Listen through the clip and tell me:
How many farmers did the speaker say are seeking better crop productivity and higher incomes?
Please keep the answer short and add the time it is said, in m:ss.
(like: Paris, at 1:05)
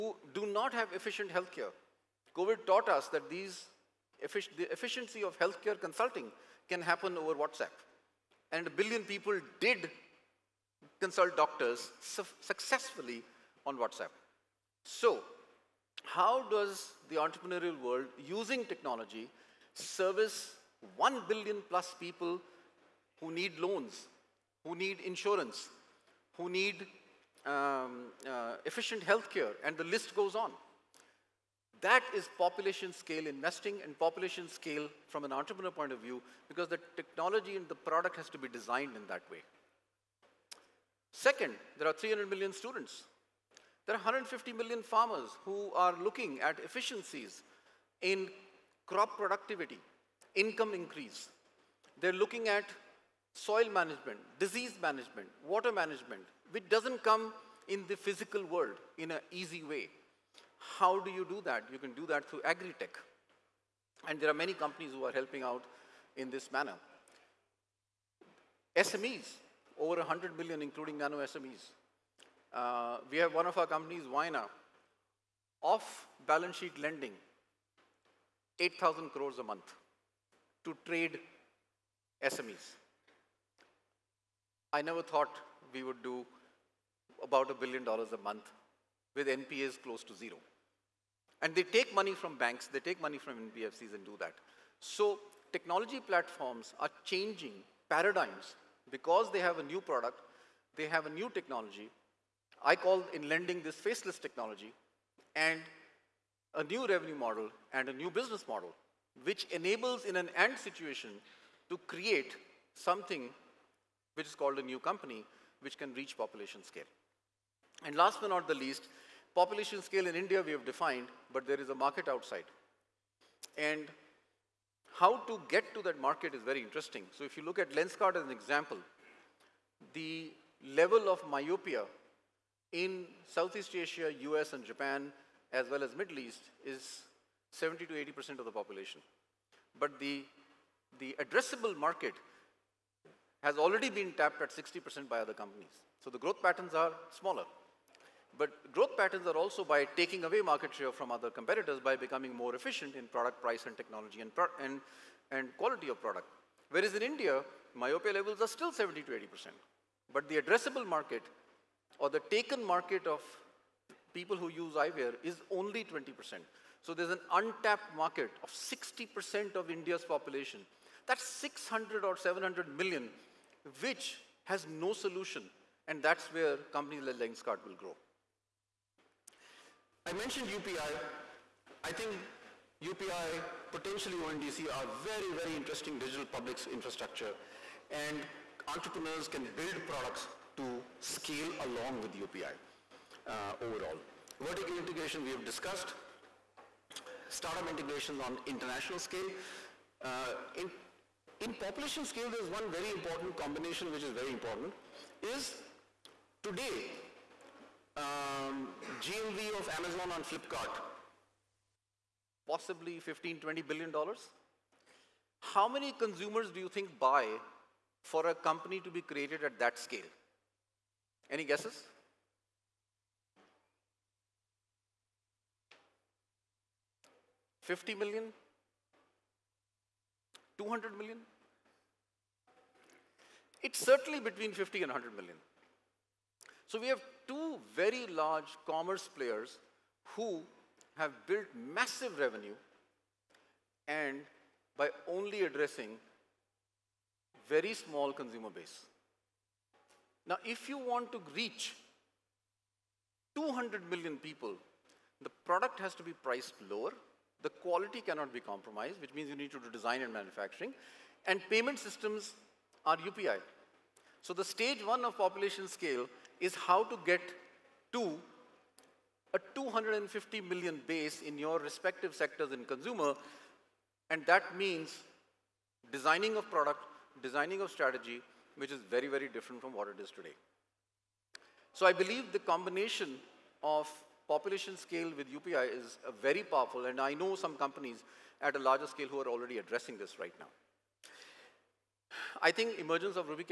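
150 million, at 0:43.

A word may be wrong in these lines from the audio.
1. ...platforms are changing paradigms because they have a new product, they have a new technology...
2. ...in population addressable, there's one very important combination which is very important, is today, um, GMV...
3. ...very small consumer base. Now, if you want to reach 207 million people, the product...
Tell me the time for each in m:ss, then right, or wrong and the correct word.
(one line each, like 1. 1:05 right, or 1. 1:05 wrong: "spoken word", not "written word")
1. 1:35 right
2. 3:21 wrong: "scale", not "addressable"
3. 4:07 wrong: "200", not "207".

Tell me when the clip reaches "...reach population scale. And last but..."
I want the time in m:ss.
1:55.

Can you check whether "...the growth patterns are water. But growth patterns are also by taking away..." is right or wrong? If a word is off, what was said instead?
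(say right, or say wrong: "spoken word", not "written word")
wrong: "smaller", not "water".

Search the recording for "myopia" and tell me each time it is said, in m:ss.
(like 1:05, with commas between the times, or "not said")
2:11, 2:37.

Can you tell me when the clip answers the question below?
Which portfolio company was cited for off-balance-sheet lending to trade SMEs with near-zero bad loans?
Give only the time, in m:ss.
1:14.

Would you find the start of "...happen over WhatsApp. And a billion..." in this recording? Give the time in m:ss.
0:06.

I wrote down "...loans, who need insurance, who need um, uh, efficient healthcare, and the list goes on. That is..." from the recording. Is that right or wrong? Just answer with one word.
right.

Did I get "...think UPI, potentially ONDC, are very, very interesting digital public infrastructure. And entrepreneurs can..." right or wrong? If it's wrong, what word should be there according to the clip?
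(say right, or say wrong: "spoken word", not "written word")
right.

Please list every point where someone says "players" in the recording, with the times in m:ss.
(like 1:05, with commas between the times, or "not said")
3:59.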